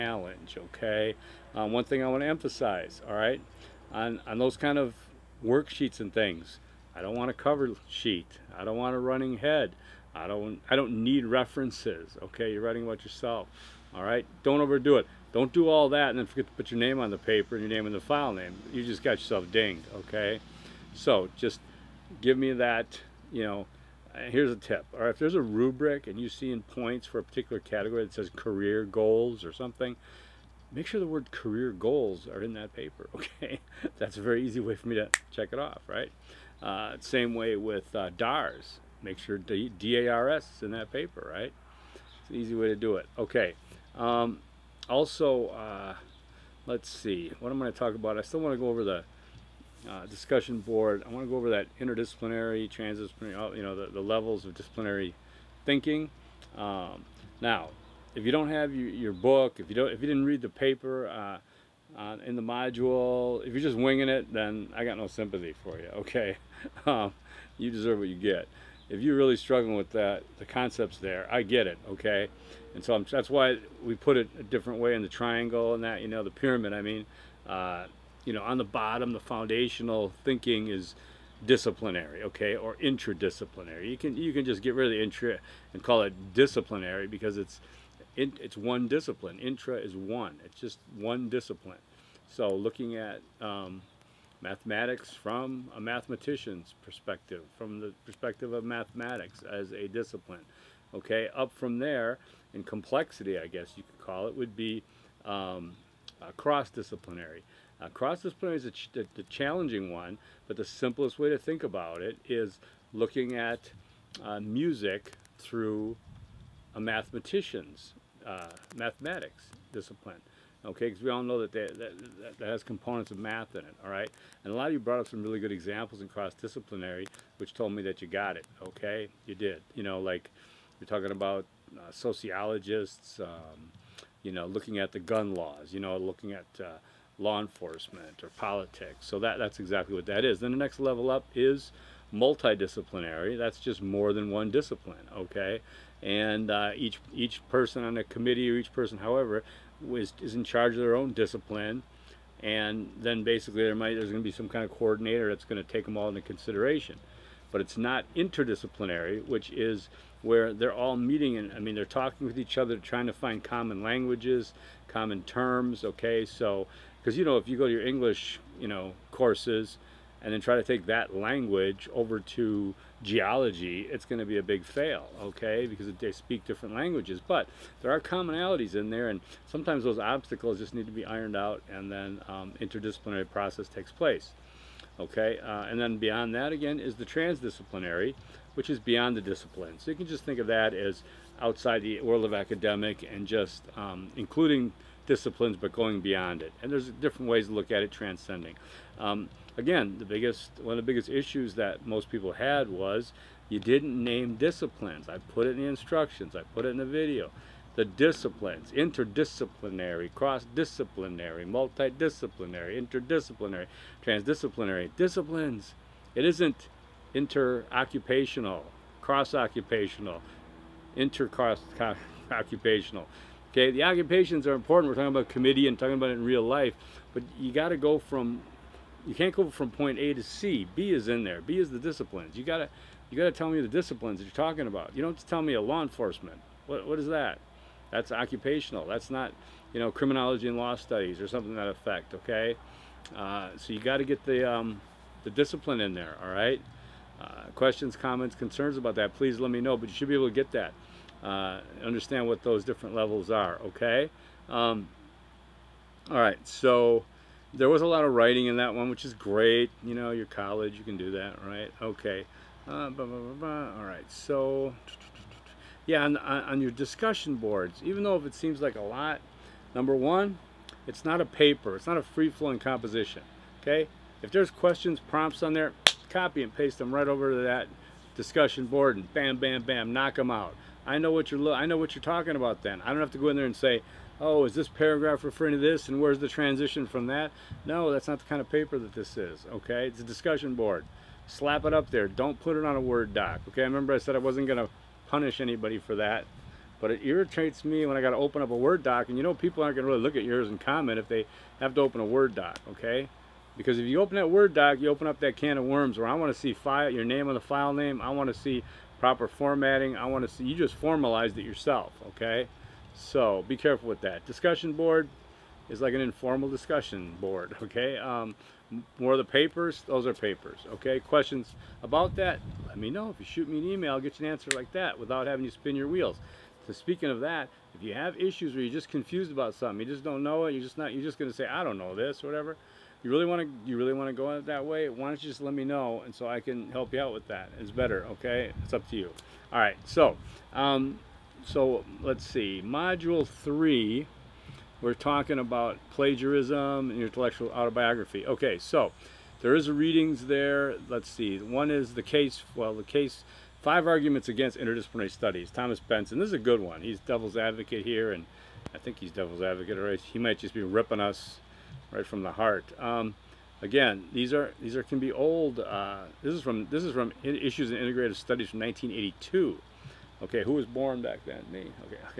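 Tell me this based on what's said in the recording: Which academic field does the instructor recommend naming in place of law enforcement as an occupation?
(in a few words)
criminology and law studies.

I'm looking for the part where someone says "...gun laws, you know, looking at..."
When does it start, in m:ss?
2:14.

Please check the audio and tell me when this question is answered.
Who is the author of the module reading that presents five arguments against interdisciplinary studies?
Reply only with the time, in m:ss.
5:55.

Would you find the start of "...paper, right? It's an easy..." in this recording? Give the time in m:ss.
0:40.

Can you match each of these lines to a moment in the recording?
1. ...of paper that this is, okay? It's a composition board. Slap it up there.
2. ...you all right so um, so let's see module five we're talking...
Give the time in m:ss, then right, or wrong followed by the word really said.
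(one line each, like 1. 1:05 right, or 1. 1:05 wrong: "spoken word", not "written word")
1. 4:48 wrong: "discussion", not "composition"
2. 5:38 wrong: "three", not "five".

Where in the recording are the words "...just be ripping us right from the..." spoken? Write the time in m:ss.
6:00.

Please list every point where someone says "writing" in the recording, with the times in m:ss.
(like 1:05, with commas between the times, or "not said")
0:12, 4:18.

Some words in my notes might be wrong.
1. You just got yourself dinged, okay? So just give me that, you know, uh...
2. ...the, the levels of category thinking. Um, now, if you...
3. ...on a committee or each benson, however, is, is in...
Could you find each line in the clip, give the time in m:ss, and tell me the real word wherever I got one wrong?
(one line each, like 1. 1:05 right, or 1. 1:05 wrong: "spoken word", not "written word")
1. 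0:18 right
2. 0:53 wrong: "disciplinary", not "category"
3. 2:27 wrong: "person", not "benson".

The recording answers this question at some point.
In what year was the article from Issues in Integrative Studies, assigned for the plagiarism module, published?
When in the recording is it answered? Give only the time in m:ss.
6:08.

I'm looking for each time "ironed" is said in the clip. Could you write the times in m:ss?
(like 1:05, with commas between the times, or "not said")
3:01.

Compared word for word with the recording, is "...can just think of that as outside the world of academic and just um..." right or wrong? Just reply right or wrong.
right.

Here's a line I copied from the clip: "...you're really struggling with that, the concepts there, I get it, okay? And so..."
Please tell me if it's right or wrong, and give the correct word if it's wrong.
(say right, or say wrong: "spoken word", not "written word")
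right.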